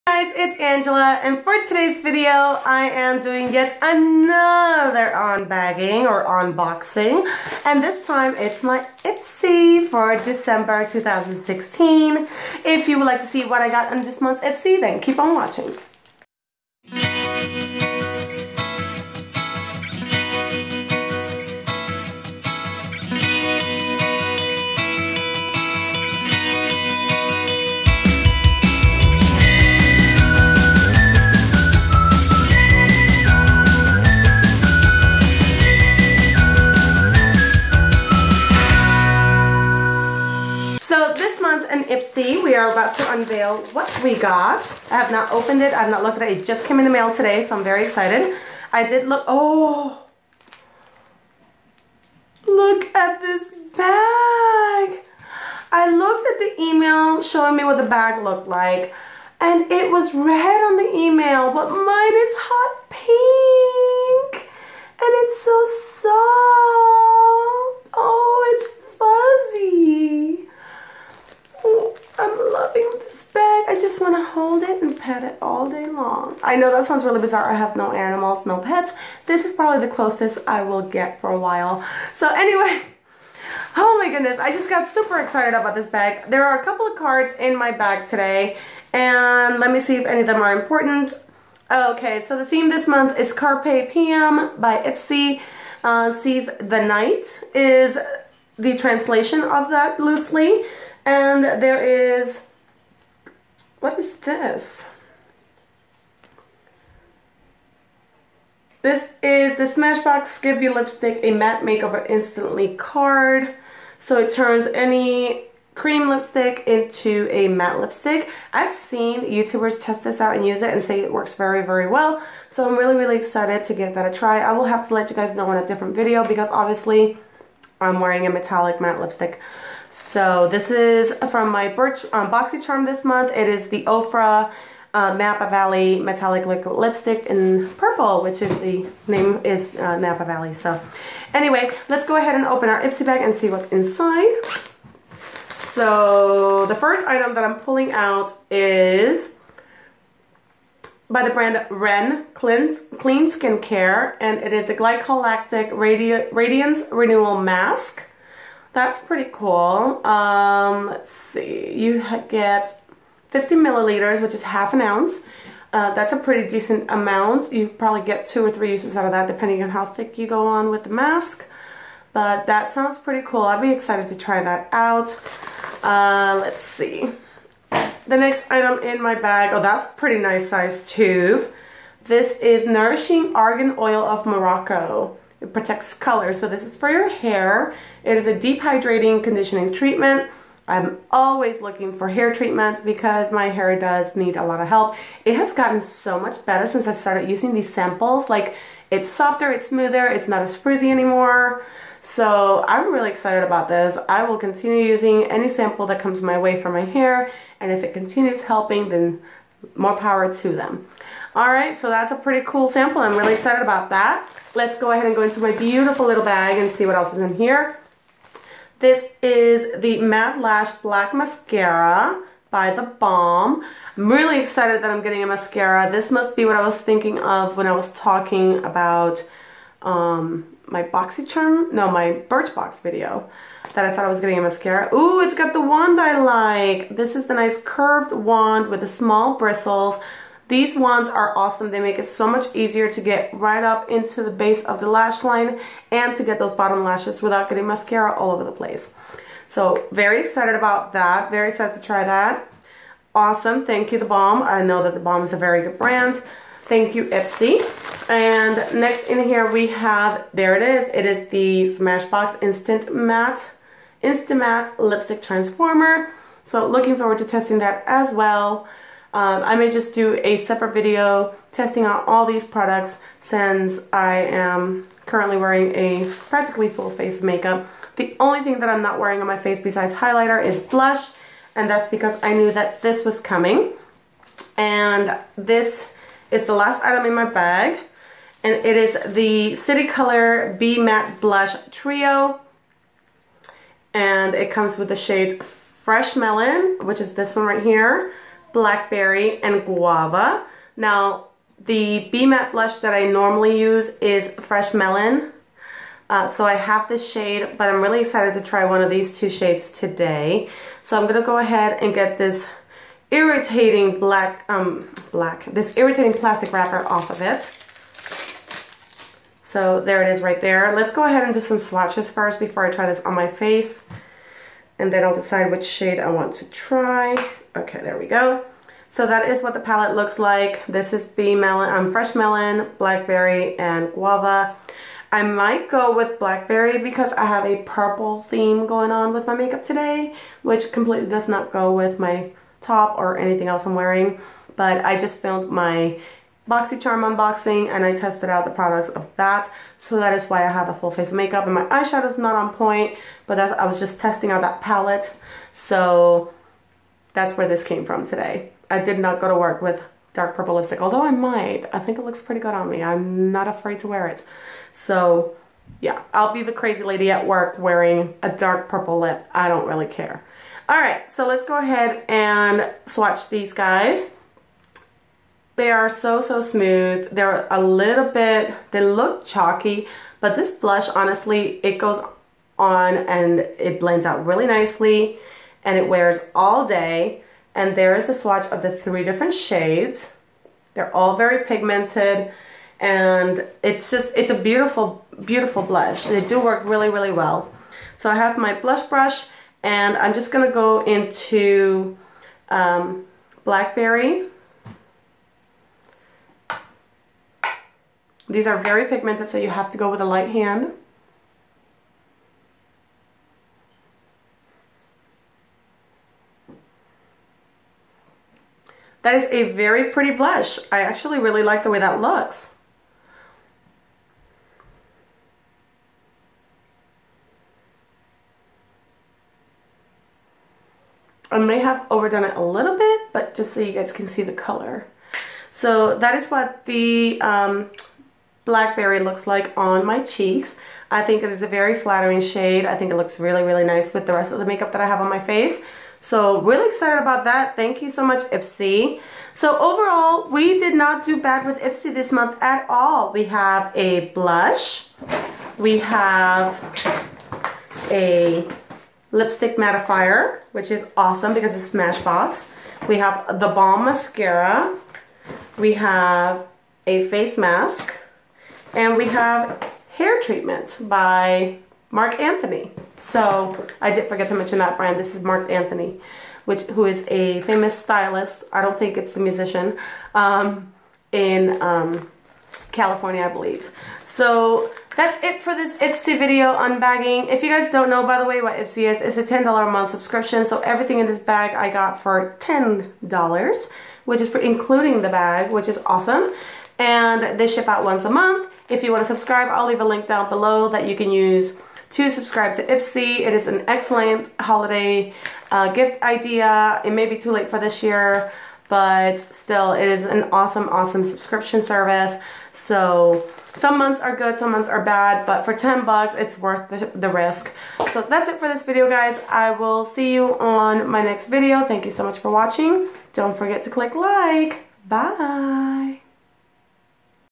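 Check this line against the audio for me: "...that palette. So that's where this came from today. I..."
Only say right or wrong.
right.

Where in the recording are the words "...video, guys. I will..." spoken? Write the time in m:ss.
8:38.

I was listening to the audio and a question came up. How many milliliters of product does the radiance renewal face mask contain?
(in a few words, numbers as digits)
50.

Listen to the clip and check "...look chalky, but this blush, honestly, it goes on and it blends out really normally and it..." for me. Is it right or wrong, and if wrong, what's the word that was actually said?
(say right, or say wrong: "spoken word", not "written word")
wrong: "nicely", not "normally".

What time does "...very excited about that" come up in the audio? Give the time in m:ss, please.
4:09.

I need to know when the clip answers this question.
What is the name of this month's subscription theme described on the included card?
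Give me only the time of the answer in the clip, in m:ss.
1:33.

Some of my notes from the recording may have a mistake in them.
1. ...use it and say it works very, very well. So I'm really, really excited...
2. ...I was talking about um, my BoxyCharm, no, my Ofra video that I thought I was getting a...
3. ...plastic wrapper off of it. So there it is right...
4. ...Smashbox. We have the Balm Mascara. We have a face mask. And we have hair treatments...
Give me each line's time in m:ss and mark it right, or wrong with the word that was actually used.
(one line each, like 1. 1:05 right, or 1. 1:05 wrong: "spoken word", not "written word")
1. 2:00 right
2. 3:47 wrong: "Birchbox", not "Ofra"
3. 5:16 right
4. 7:41 right.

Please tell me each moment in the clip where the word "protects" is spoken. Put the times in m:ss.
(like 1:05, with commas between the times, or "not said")
3:05.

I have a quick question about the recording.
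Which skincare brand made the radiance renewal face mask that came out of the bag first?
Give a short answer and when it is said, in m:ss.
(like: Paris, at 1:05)
Ren Clean Skin Care, at 2:31.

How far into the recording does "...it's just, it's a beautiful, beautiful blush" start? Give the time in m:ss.
6:33.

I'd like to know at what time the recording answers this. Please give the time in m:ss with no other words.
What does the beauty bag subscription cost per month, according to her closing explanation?
8:09.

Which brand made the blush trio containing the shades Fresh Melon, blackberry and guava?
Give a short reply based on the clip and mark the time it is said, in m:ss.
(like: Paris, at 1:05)
City Color, at 4:49.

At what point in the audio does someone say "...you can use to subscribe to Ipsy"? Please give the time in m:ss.
8:20.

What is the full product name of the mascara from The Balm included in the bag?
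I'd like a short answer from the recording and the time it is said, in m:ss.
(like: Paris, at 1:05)
Matte Lash Black Mascara, at 3:39.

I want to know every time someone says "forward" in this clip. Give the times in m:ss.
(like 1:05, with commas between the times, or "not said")
4:26.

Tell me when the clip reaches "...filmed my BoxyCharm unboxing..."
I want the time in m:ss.
5:45.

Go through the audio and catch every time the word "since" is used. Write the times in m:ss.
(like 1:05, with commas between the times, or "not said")
3:16, 4:33.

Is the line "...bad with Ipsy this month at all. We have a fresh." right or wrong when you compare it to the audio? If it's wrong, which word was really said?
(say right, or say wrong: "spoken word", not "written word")
wrong: "blush", not "fresh".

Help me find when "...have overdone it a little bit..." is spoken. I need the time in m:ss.
7:11.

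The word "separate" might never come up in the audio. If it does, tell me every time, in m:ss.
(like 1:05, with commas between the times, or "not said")
4:30.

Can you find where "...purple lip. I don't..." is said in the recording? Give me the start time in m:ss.
6:08.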